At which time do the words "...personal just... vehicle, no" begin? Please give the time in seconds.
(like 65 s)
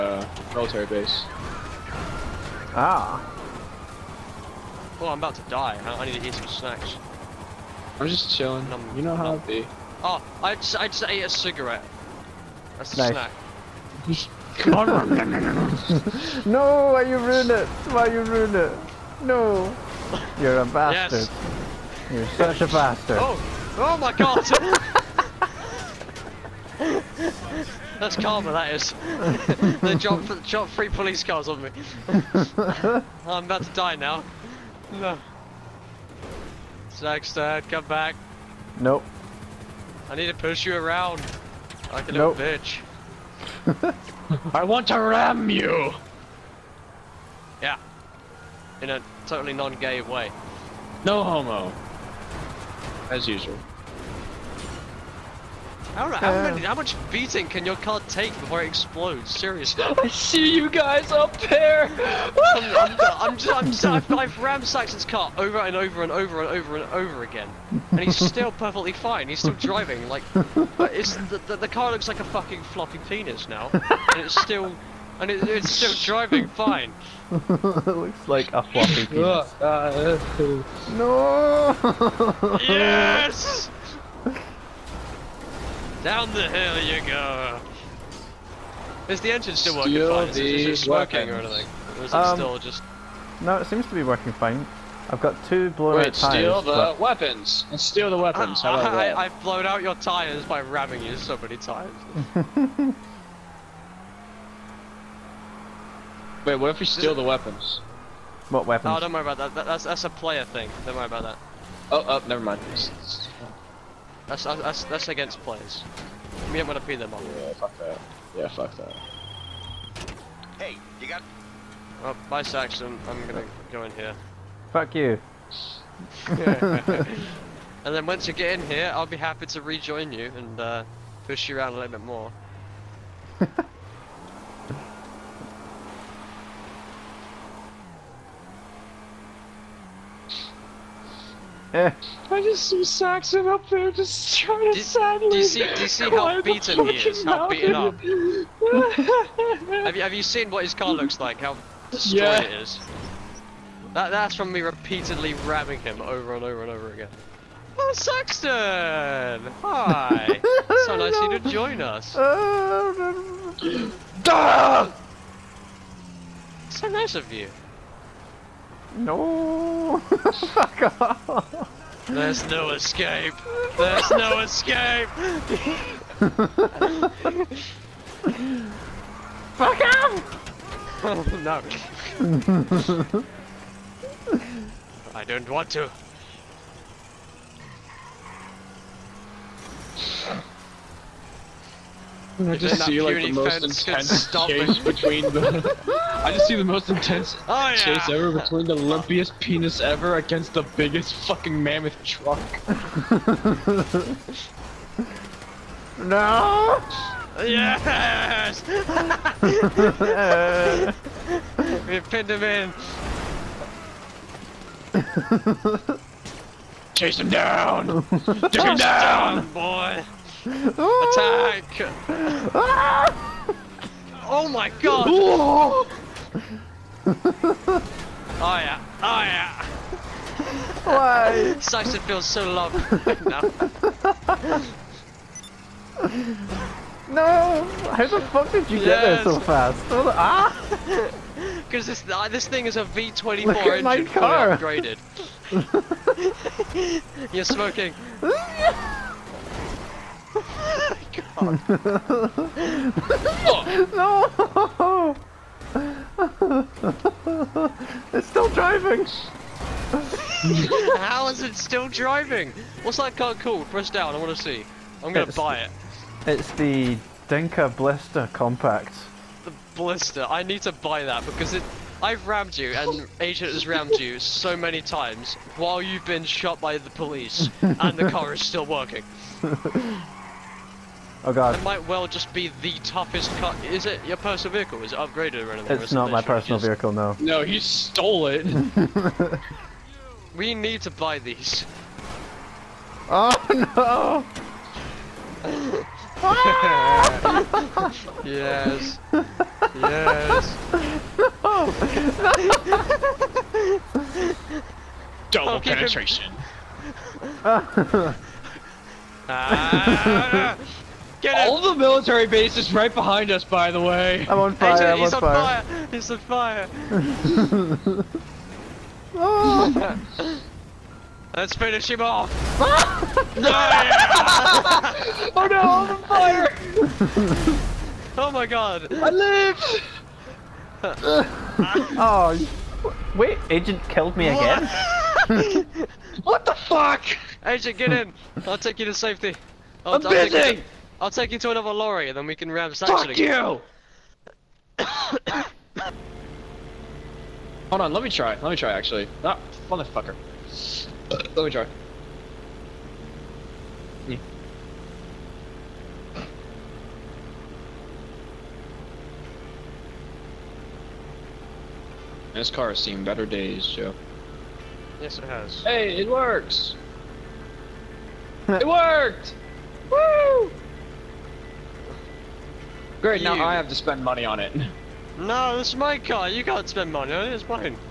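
286 s.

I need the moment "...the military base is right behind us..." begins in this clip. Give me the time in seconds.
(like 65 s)
311 s.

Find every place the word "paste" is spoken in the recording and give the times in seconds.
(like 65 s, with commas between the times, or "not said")
not said.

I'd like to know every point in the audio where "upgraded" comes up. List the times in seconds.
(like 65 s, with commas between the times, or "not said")
244 s, 284 s.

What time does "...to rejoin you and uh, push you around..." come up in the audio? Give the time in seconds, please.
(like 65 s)
129 s.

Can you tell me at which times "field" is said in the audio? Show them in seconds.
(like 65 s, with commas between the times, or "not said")
not said.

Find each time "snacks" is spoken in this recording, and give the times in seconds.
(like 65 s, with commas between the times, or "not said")
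6 s, 14 s.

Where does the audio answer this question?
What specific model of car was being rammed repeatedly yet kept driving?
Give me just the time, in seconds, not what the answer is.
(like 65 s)
267 s.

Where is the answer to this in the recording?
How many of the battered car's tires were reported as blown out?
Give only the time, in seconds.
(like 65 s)
95 s.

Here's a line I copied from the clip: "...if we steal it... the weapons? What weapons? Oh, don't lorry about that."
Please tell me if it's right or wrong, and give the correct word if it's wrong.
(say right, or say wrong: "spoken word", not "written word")
wrong: "worry", not "lorry".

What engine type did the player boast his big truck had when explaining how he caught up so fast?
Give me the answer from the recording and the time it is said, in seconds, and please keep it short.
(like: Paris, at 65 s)
V24, at 242 s.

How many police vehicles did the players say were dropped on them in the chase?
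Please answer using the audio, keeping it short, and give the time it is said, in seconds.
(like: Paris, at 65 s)
3, at 30 s.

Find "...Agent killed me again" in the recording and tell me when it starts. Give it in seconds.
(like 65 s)
333 s.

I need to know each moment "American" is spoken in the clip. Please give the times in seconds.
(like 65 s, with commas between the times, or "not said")
not said.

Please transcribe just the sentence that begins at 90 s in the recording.
Is it just working or anything?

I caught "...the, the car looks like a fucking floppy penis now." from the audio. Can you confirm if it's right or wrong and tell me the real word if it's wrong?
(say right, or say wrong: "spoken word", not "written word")
right.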